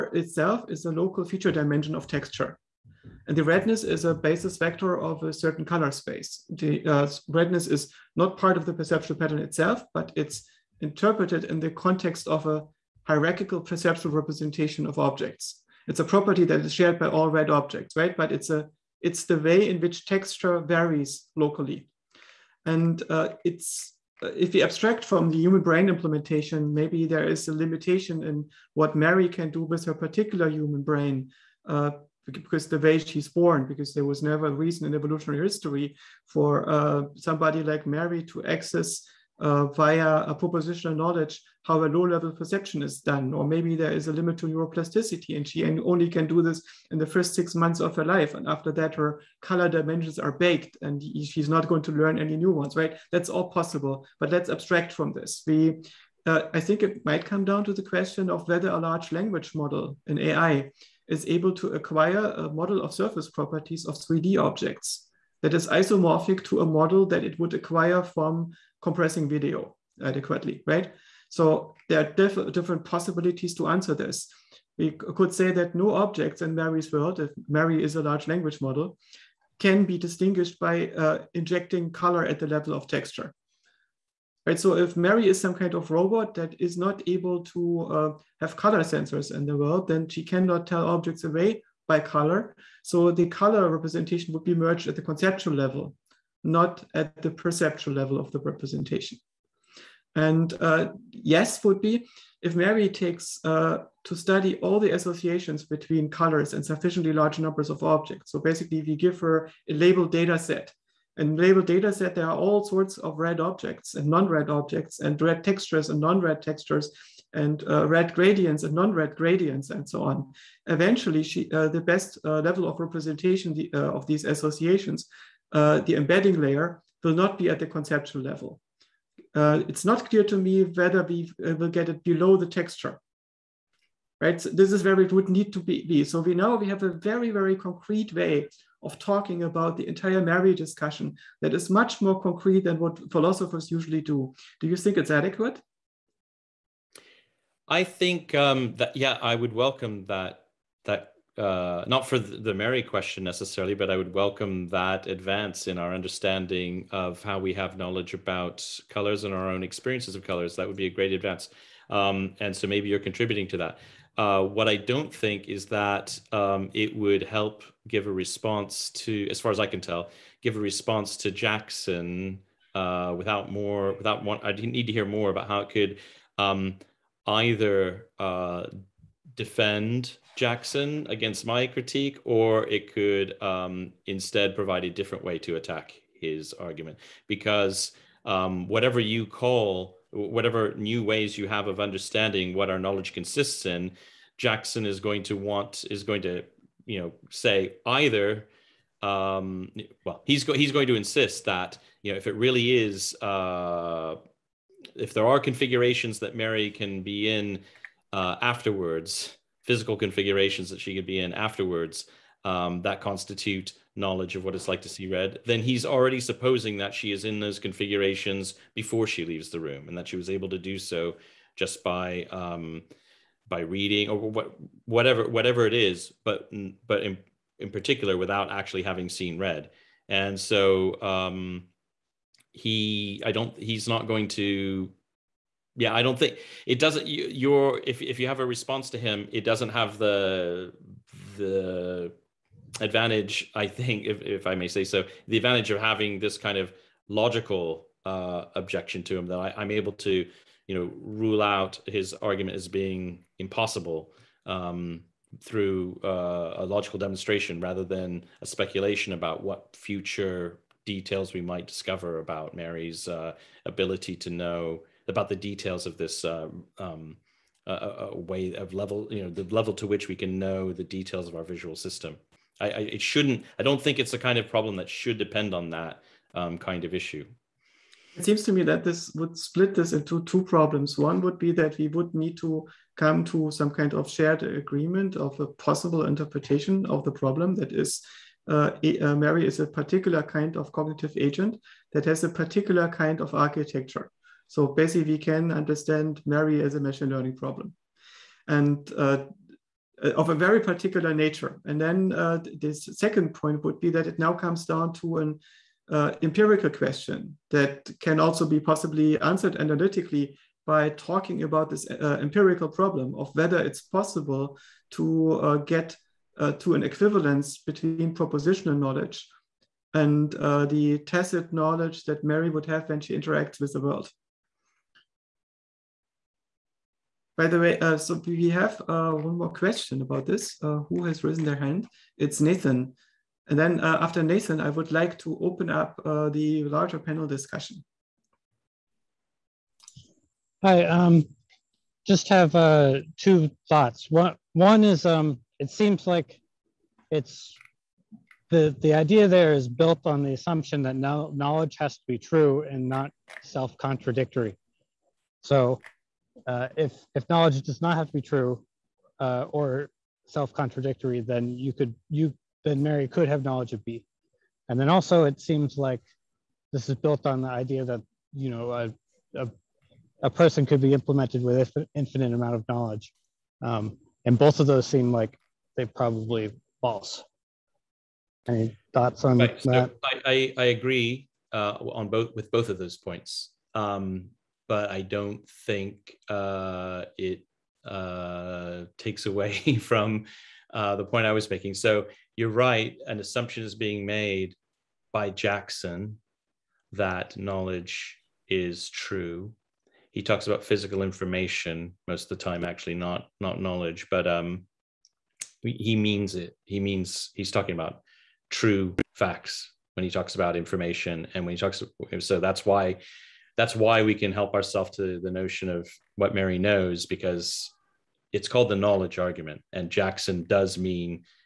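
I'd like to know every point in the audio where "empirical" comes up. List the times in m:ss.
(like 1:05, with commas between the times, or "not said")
5:06, 5:11.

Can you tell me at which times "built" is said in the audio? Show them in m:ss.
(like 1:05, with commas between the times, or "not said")
5:49, 6:06.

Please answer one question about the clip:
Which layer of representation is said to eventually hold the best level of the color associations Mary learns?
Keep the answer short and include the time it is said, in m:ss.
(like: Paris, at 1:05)
the embedding layer, at 2:05.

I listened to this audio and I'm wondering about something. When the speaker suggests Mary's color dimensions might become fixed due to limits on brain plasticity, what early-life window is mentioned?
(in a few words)
first six months.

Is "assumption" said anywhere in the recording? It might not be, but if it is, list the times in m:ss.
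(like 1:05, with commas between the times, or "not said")
5:50, 6:33.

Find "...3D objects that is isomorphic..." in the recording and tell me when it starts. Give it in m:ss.
1:03.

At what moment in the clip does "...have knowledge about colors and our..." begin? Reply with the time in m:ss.
2:37.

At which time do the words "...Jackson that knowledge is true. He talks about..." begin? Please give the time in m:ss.
6:35.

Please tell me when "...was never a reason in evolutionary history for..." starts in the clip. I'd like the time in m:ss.
0:34.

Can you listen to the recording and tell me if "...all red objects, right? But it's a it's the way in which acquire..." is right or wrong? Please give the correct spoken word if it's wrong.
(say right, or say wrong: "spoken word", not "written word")
wrong: "texture", not "acquire".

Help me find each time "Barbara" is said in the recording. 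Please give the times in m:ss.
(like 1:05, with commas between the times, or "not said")
not said.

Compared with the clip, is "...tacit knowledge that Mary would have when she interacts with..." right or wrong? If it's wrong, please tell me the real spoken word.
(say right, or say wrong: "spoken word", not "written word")
right.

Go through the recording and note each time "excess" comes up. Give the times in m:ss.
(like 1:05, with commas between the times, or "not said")
not said.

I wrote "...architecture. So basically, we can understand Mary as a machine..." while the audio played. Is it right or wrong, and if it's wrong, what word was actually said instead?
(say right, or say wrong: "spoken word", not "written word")
right.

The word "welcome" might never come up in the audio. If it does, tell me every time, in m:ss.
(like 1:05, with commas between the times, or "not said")
2:29, 2:34.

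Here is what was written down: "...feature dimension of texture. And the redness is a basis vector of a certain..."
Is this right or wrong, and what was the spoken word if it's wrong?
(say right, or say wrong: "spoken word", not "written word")
right.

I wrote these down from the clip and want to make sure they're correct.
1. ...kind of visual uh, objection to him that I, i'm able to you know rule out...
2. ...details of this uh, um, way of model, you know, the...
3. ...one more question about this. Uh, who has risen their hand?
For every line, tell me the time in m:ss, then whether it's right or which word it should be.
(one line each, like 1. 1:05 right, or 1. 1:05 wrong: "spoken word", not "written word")
1. 4:06 wrong: "logical", not "visual"
2. 4:25 wrong: "level", not "model"
3. 5:29 right.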